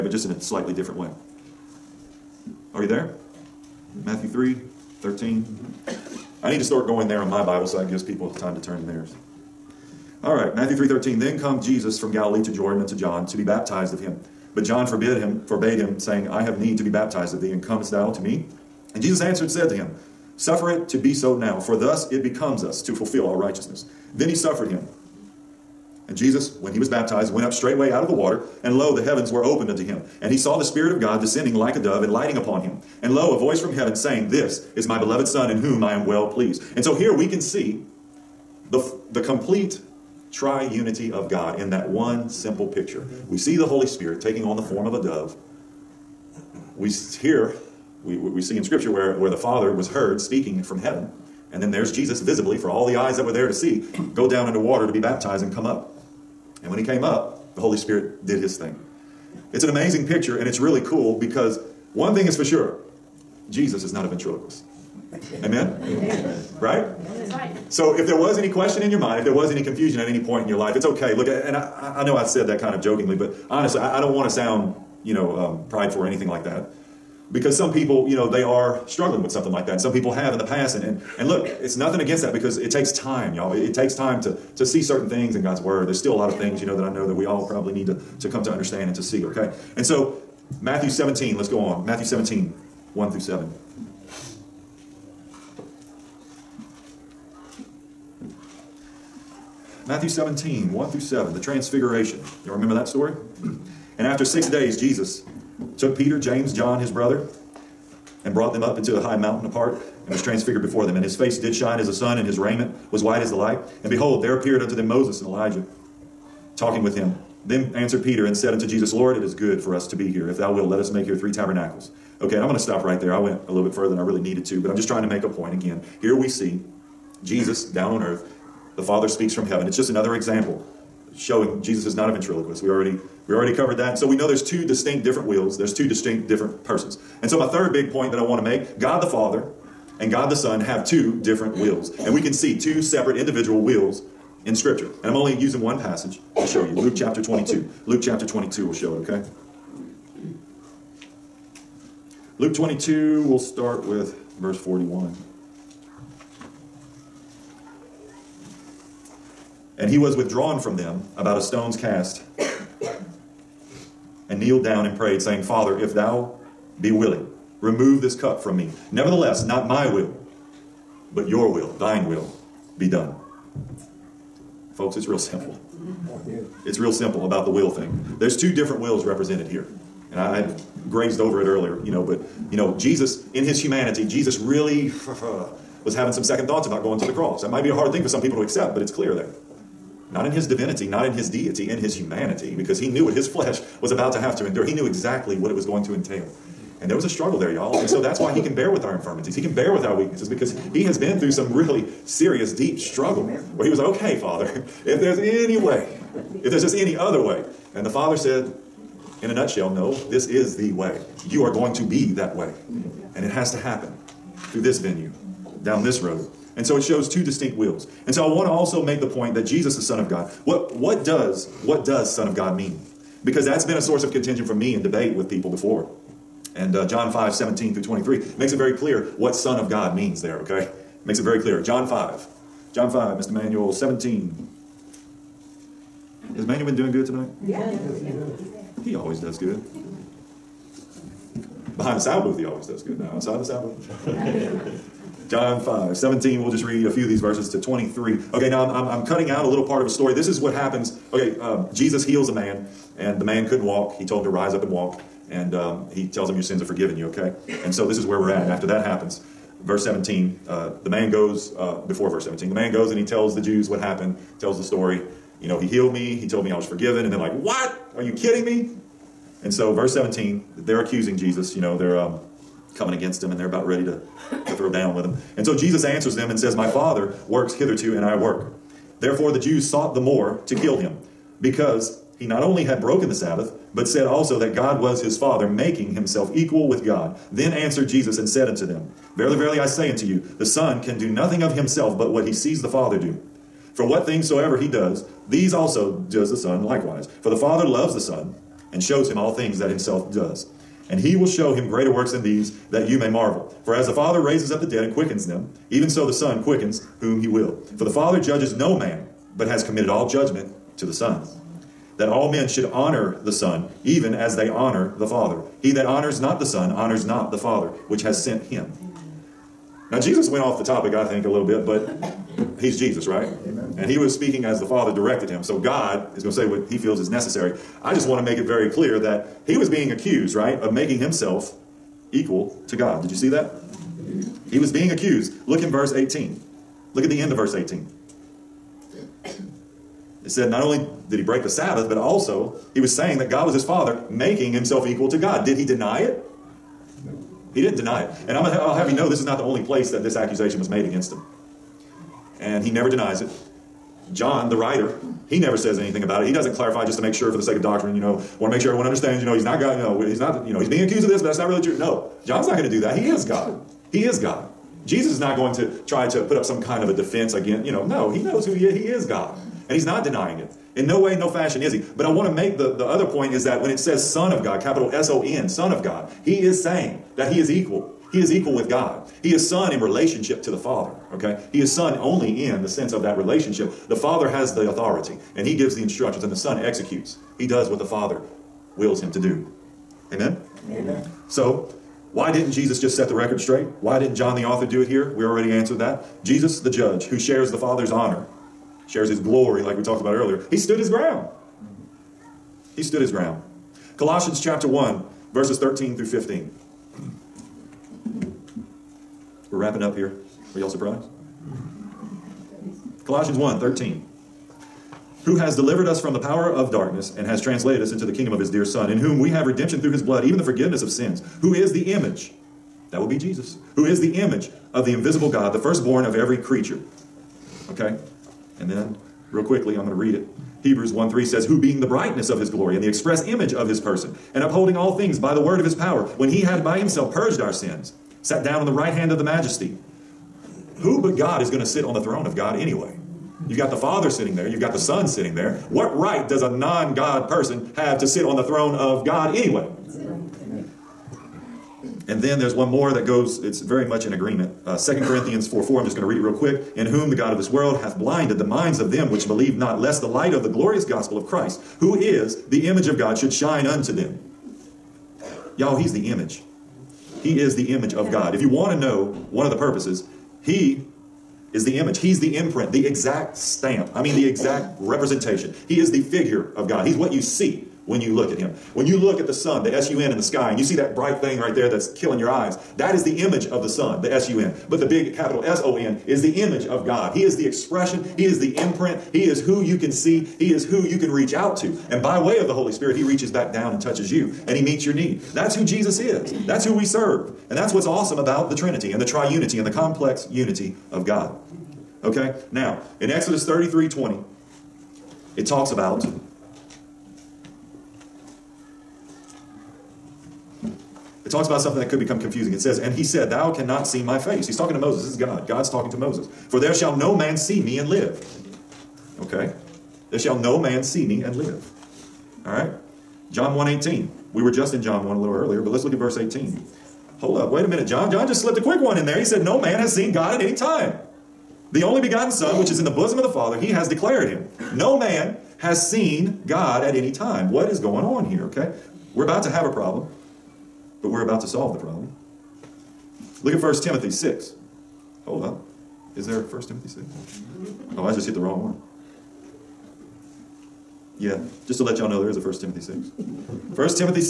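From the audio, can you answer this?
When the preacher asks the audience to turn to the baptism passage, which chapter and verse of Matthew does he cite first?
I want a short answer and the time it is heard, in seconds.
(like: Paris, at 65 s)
Matthew 3:13, at 4 s.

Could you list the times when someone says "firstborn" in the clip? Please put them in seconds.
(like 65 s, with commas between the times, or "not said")
425 s.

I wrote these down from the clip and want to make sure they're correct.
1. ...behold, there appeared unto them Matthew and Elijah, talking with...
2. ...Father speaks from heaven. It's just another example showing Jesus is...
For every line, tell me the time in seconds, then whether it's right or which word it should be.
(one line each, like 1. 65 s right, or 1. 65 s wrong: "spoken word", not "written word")
1. 113 s wrong: "Moses", not "Matthew"
2. 128 s right.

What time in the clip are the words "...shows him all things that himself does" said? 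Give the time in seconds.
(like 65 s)
298 s.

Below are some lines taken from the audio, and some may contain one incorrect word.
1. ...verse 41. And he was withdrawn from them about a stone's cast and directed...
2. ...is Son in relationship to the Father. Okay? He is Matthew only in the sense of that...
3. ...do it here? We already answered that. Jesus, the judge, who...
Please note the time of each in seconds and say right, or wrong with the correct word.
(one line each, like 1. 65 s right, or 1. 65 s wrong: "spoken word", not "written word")
1. 154 s wrong: "kneeled", not "directed"
2. 379 s wrong: "Son", not "Matthew"
3. 394 s right.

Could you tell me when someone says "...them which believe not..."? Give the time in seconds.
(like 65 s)
458 s.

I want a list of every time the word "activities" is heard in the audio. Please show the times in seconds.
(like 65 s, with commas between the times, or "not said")
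not said.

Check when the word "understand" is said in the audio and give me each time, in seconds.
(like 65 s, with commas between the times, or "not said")
88 s, 358 s.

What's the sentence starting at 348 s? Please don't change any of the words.
And I'm, I'll have you know this is not the only place that this accusation was made against him.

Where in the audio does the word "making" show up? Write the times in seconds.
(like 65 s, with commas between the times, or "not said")
285 s, 330 s, 344 s.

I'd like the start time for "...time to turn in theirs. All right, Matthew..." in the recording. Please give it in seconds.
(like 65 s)
8 s.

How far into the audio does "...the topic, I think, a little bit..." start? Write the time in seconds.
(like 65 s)
320 s.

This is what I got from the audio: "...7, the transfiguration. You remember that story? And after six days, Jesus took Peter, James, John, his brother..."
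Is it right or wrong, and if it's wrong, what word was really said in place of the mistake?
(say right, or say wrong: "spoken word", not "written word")
right.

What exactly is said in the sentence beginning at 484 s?
But the big capital S O N is the image of God.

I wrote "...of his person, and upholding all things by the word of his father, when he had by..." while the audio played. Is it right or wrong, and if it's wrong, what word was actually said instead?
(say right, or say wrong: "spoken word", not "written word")
wrong: "power", not "father".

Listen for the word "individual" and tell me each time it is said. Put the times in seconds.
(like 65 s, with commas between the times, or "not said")
143 s.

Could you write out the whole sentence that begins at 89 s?
And so, Matthew 17, let's go on.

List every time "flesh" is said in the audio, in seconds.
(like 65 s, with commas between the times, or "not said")
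193 s.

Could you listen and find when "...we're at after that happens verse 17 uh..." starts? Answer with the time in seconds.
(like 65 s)
258 s.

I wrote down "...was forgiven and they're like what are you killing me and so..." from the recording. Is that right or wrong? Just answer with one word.
wrong.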